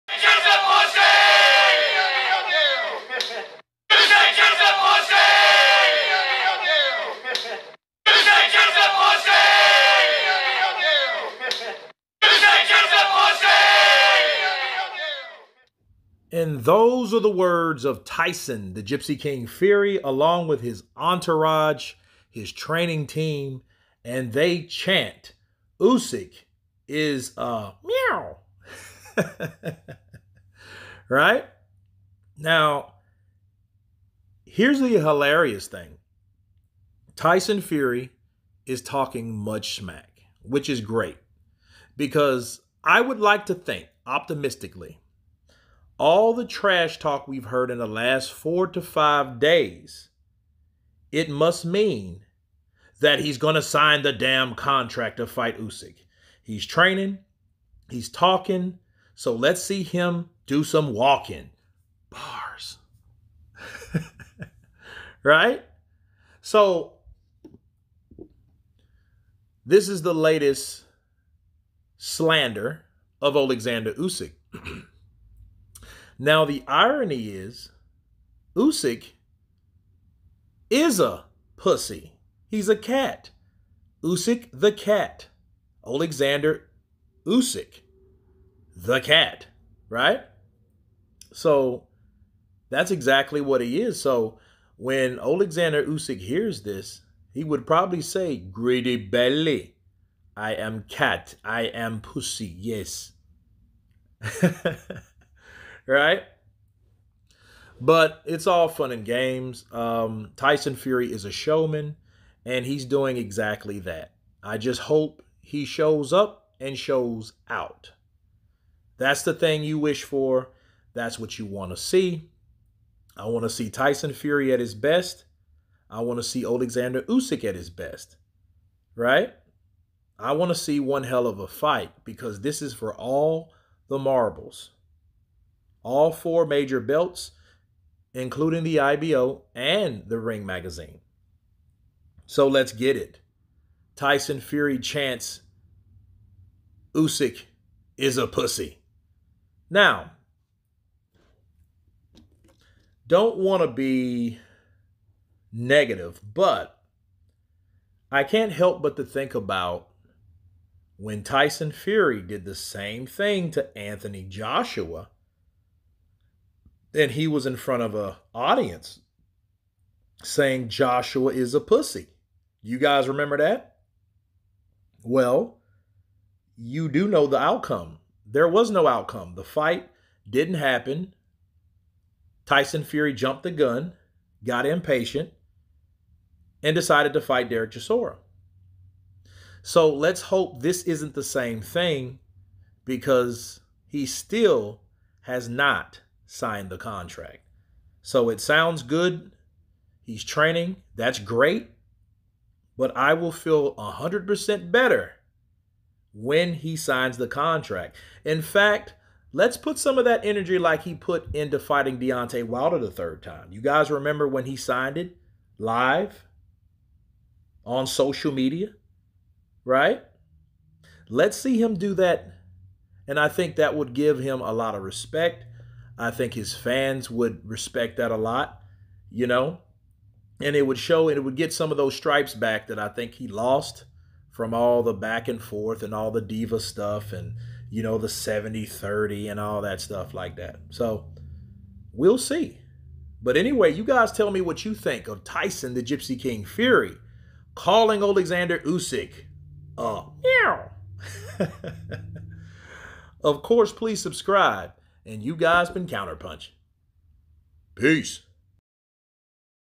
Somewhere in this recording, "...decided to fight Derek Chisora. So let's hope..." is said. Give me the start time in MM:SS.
03:06.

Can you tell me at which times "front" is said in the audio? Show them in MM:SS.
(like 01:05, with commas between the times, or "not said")
02:47.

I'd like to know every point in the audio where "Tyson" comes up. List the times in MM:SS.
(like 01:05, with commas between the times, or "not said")
00:18, 00:37, 01:50, 02:03, 02:23, 02:41, 03:02, 04:05.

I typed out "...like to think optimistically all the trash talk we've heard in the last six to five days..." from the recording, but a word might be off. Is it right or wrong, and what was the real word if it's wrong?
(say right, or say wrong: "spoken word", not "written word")
wrong: "four", not "six".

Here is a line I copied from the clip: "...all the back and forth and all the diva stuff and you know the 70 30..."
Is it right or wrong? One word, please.
right.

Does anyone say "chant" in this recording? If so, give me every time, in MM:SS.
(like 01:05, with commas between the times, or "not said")
00:24, 02:24.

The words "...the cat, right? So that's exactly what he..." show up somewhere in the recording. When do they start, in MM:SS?
01:28.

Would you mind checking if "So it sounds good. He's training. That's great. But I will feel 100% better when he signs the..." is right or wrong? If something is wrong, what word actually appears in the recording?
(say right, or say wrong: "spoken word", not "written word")
right.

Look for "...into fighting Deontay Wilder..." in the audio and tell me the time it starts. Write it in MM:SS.
03:31.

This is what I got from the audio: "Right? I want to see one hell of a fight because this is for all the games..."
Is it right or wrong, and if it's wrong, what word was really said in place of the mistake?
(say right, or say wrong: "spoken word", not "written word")
wrong: "marbles", not "games".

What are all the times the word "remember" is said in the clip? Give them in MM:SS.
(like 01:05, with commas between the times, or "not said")
02:53, 03:33.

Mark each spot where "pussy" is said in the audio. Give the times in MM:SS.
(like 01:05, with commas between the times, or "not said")
01:21, 01:41, 02:28, 02:51.